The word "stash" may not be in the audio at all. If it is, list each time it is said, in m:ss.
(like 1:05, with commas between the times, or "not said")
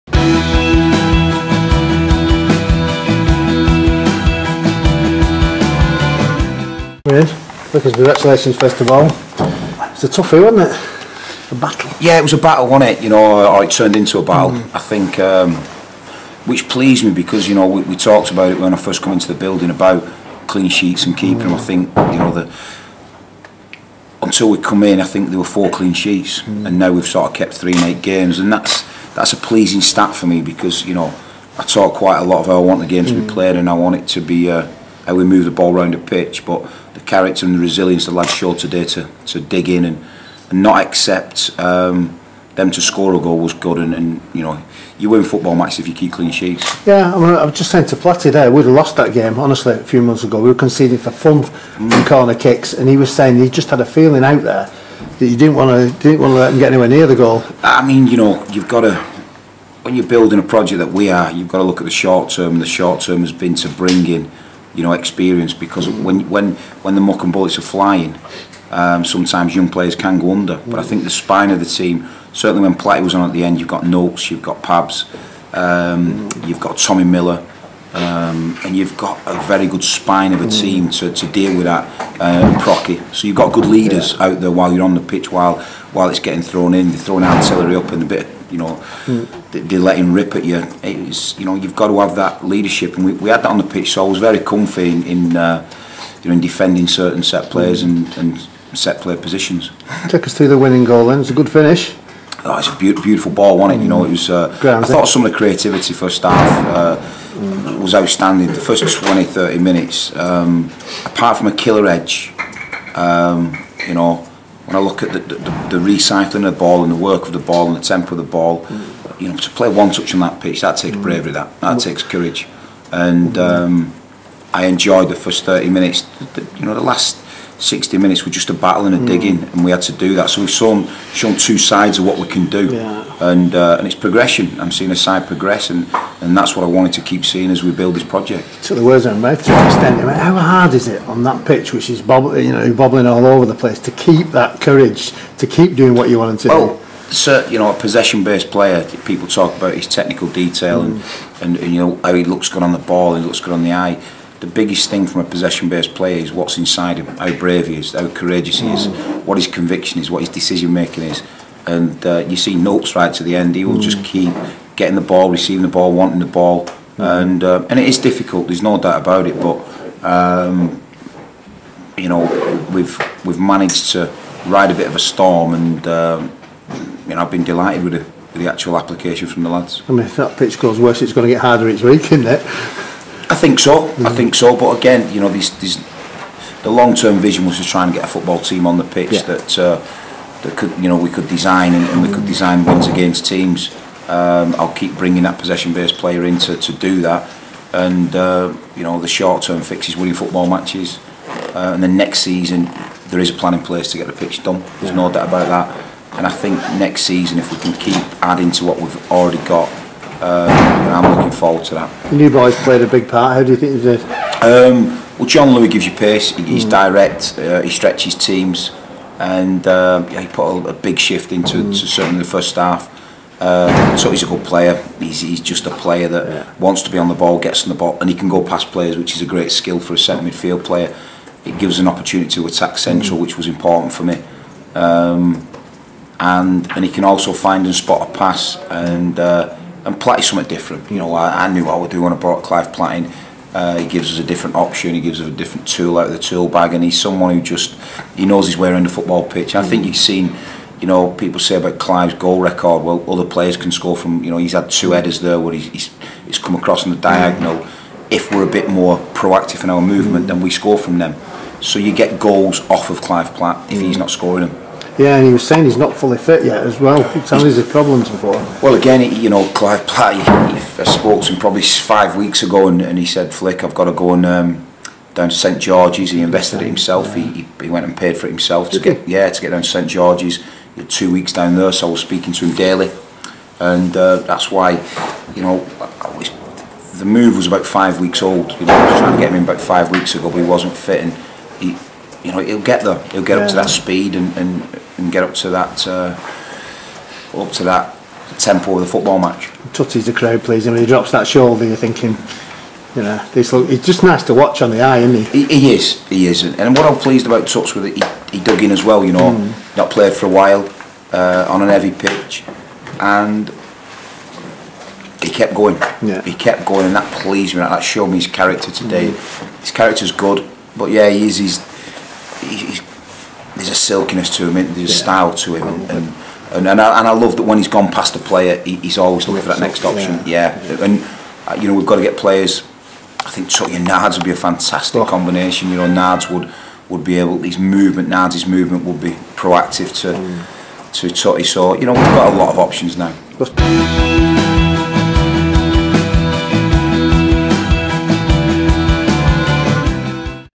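not said.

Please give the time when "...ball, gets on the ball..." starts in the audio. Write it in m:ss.
3:47.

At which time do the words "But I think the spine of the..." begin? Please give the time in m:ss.
1:10.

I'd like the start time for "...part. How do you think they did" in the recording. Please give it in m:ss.
3:33.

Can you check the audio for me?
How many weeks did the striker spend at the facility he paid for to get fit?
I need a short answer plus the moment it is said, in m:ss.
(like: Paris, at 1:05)
2, at 4:40.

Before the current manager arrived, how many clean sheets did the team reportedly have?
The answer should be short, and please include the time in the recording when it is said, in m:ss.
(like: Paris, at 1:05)
4, at 0:25.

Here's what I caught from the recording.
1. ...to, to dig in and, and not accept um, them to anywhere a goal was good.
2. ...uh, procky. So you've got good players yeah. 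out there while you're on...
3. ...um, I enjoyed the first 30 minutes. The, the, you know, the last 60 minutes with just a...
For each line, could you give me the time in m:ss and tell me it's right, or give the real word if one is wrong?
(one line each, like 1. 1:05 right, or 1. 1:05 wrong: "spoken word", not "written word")
1. 0:38 wrong: "score", not "anywhere"
2. 1:22 wrong: "leaders", not "players"
3. 2:03 right.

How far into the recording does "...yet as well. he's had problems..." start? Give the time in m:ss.
4:26.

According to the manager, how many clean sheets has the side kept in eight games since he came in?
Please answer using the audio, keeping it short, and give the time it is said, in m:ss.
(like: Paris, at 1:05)
3, at 0:27.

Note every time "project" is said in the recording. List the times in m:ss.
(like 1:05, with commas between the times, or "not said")
1:00, 2:18.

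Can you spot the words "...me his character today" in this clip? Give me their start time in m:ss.
5:18.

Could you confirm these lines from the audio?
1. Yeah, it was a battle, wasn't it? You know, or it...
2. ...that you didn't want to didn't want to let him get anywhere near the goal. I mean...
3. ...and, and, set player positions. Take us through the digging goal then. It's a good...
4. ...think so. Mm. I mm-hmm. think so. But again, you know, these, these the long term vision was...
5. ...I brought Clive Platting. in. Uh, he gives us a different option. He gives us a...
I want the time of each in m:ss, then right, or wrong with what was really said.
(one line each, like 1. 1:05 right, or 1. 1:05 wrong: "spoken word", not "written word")
1. 0:12 right
2. 0:55 right
3. 1:37 wrong: "winning", not "digging"
4. 3:03 right
5. 4:02 right.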